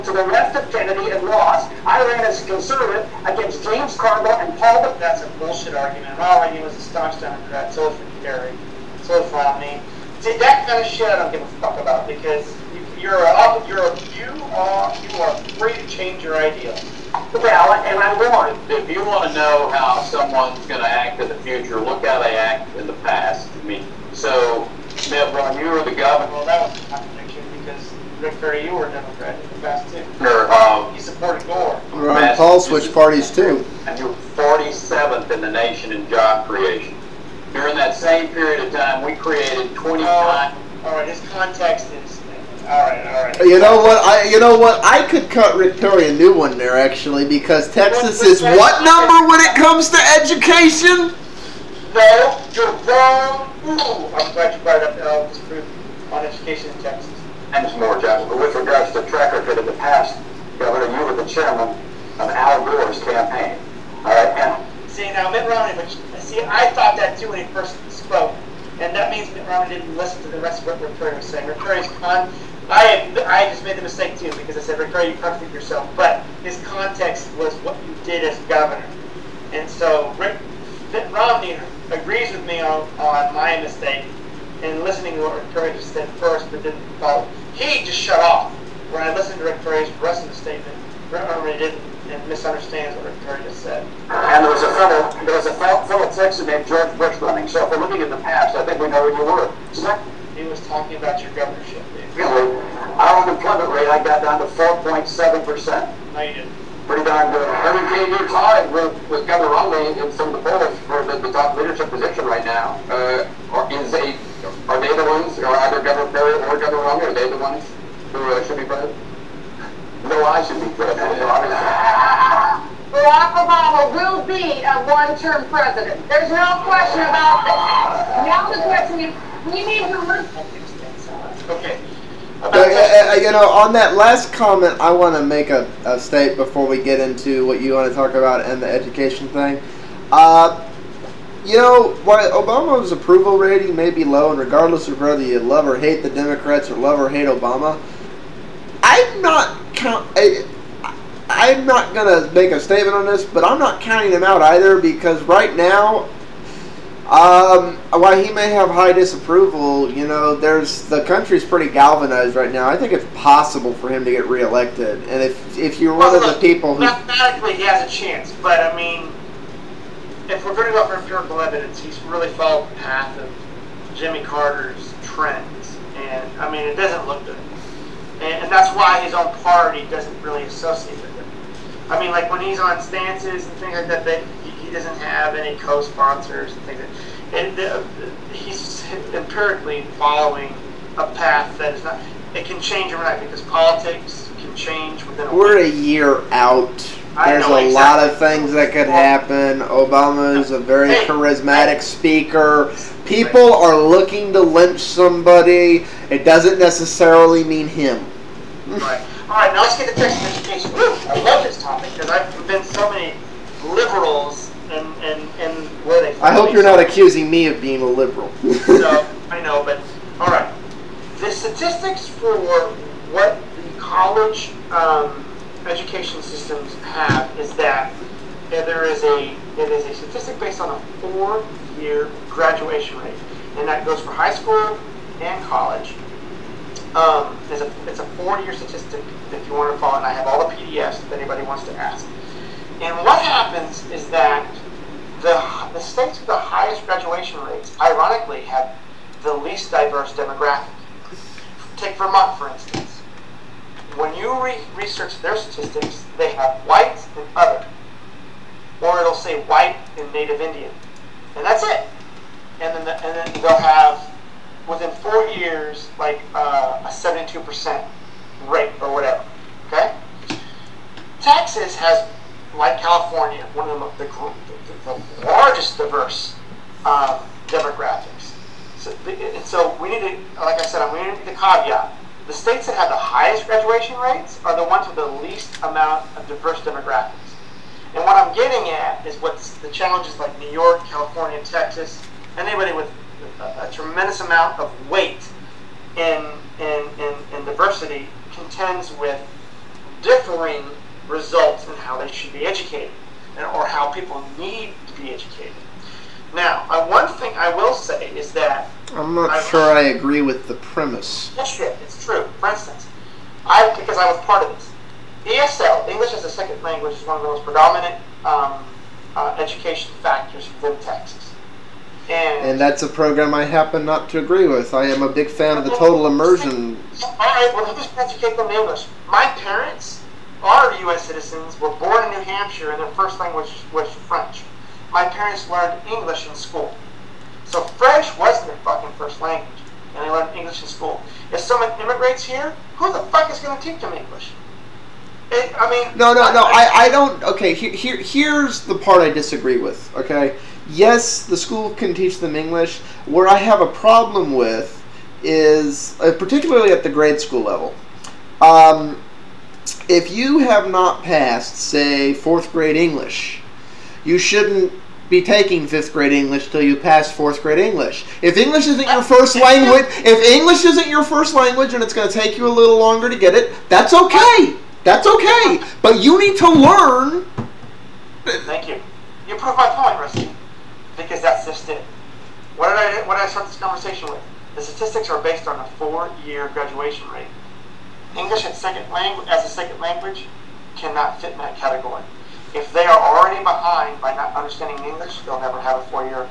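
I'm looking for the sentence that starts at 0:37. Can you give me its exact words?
During that same period of time, we created 25.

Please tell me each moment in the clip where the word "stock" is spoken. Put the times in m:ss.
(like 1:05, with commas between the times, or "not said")
not said.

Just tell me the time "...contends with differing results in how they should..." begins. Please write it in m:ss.
4:58.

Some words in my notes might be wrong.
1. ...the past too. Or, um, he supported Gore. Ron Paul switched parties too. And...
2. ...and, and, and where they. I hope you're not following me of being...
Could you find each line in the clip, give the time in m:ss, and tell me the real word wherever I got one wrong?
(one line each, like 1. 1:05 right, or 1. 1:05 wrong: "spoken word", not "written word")
1. 0:29 right
2. 3:34 wrong: "accusing", not "following".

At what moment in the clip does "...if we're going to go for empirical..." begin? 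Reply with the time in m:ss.
2:50.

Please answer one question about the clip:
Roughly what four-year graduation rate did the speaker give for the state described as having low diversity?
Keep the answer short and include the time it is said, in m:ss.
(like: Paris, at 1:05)
72%, at 4:26.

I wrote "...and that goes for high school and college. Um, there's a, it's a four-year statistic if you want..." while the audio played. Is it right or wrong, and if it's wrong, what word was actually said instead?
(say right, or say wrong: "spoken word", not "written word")
right.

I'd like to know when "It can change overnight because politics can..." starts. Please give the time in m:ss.
3:12.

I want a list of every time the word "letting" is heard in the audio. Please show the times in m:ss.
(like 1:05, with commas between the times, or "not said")
not said.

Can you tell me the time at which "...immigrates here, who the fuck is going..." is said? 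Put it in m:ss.
5:41.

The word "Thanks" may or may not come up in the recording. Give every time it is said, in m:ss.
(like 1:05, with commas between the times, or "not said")
0:57, 6:18.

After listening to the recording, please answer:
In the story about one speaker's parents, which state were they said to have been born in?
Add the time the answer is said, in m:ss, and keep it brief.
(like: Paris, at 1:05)
New Hampshire, at 5:32.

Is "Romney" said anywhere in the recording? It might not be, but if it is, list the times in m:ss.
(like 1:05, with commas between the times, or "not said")
1:05, 1:09, 1:21, 1:31, 1:49, 1:56.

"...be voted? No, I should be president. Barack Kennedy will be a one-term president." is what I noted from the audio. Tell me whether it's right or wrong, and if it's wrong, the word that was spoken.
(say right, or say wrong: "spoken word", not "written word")
wrong: "Obama", not "Kennedy".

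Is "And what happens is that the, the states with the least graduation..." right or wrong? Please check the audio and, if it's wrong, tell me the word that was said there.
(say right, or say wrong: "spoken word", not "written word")
wrong: "highest", not "least".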